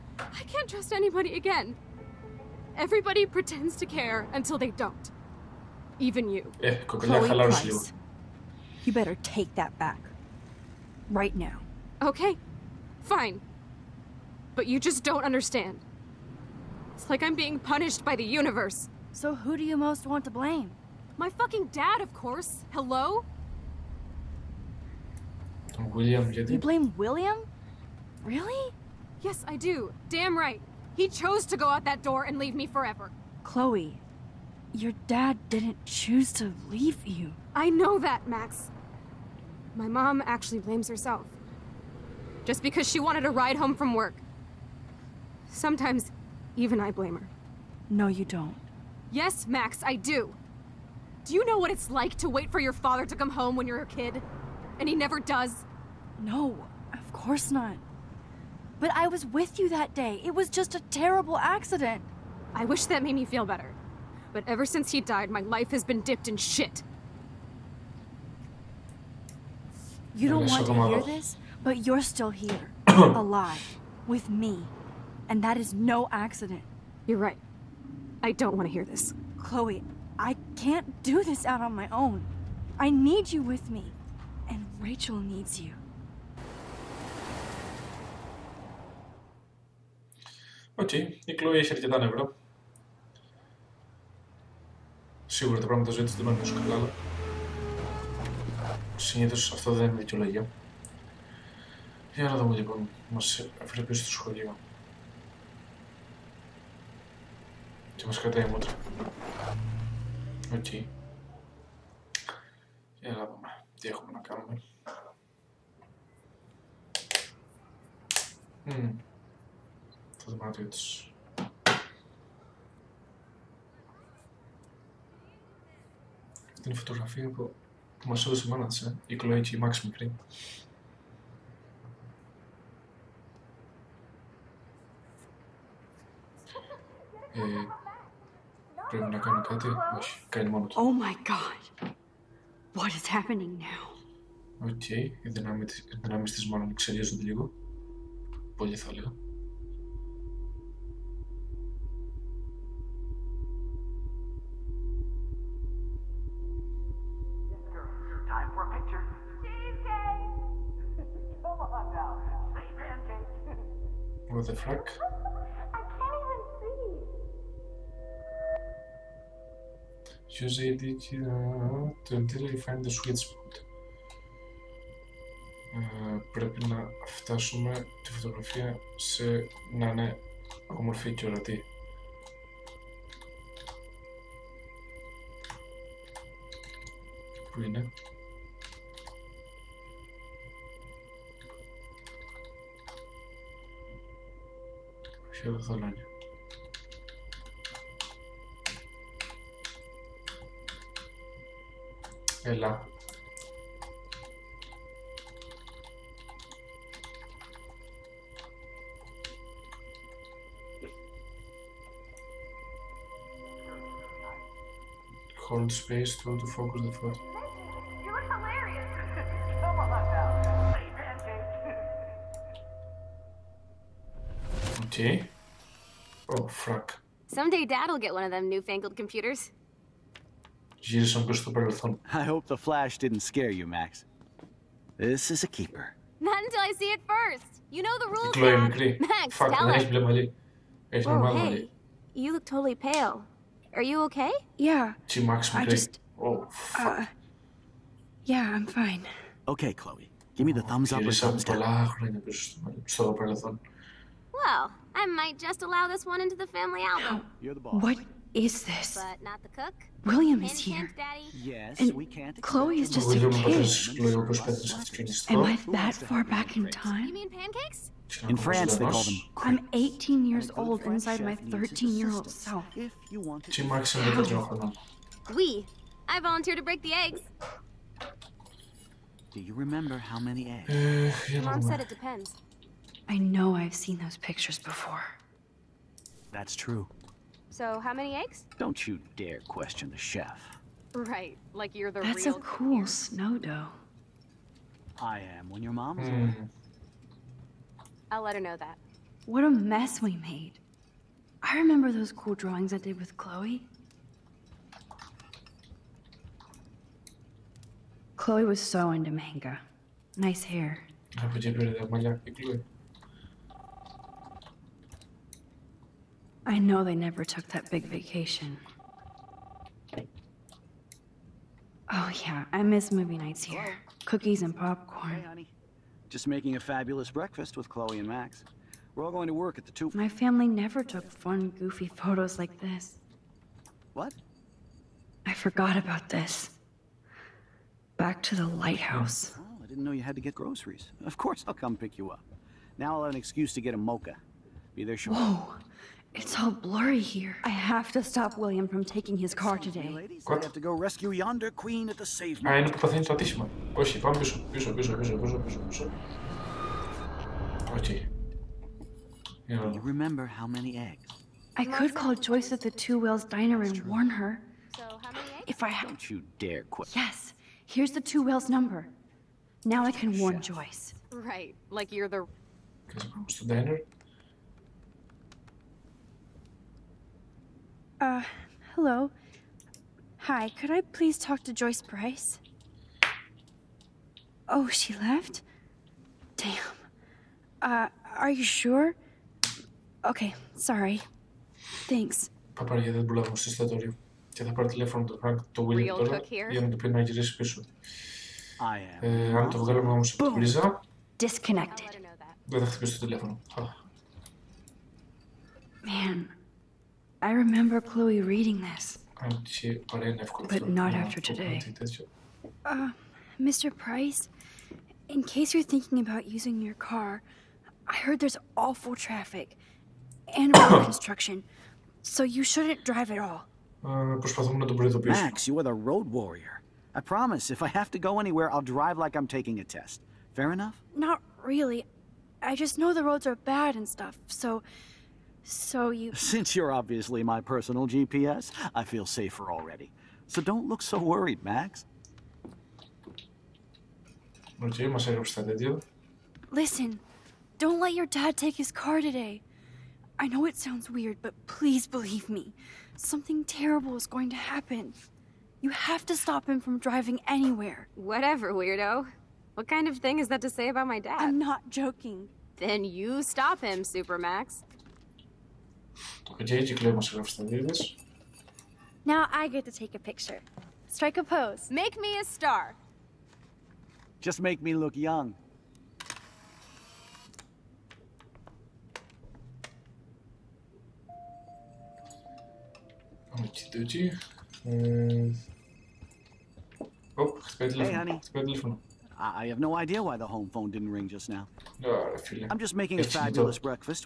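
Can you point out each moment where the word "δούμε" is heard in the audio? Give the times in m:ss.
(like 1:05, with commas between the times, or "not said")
1:42, 1:53.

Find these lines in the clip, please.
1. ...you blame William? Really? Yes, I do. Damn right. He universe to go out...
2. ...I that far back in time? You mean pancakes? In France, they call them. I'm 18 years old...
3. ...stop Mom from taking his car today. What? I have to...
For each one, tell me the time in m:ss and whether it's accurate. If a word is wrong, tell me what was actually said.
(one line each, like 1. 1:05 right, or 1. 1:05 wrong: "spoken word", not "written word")
1. 0:26 wrong: "chose", not "universe"
2. 4:25 right
3. 5:48 wrong: "William", not "Mom".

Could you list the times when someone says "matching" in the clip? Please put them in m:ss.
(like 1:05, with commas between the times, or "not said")
not said.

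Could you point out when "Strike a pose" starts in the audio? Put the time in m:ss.
7:50.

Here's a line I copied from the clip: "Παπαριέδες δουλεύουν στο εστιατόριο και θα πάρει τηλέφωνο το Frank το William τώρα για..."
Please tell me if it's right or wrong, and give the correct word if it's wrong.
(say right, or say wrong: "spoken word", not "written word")
right.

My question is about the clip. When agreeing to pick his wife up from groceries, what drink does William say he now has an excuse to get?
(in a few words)
A mocha.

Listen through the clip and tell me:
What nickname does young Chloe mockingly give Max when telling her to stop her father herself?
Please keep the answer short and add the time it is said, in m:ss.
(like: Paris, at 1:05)
Supermax, at 7:43.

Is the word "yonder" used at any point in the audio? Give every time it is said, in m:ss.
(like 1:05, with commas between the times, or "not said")
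5:51.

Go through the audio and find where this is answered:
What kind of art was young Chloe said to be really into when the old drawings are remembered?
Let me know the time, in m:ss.
5:09.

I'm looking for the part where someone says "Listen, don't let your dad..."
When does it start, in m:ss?
7:26.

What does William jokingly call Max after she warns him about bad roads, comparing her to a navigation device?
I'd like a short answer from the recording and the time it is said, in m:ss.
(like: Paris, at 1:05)
Personal GPS, at 7:17.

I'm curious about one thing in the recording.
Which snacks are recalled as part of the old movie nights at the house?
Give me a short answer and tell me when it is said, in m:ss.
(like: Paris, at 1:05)
Cookies and popcorn, at 5:24.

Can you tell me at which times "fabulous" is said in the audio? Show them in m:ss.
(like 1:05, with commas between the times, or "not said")
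5:26, 8:13.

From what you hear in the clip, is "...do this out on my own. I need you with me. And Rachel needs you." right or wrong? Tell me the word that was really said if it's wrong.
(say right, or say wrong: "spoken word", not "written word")
right.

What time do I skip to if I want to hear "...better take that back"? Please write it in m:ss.
0:08.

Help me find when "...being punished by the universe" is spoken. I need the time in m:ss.
0:17.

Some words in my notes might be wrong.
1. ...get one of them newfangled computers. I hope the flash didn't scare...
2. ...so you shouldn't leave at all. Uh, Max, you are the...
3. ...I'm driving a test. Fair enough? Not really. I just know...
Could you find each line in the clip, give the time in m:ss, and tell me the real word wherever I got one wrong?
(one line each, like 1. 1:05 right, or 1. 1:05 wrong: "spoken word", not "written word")
1. 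3:47 right
2. 7:02 wrong: "drive", not "leave"
3. 7:09 wrong: "taking", not "driving".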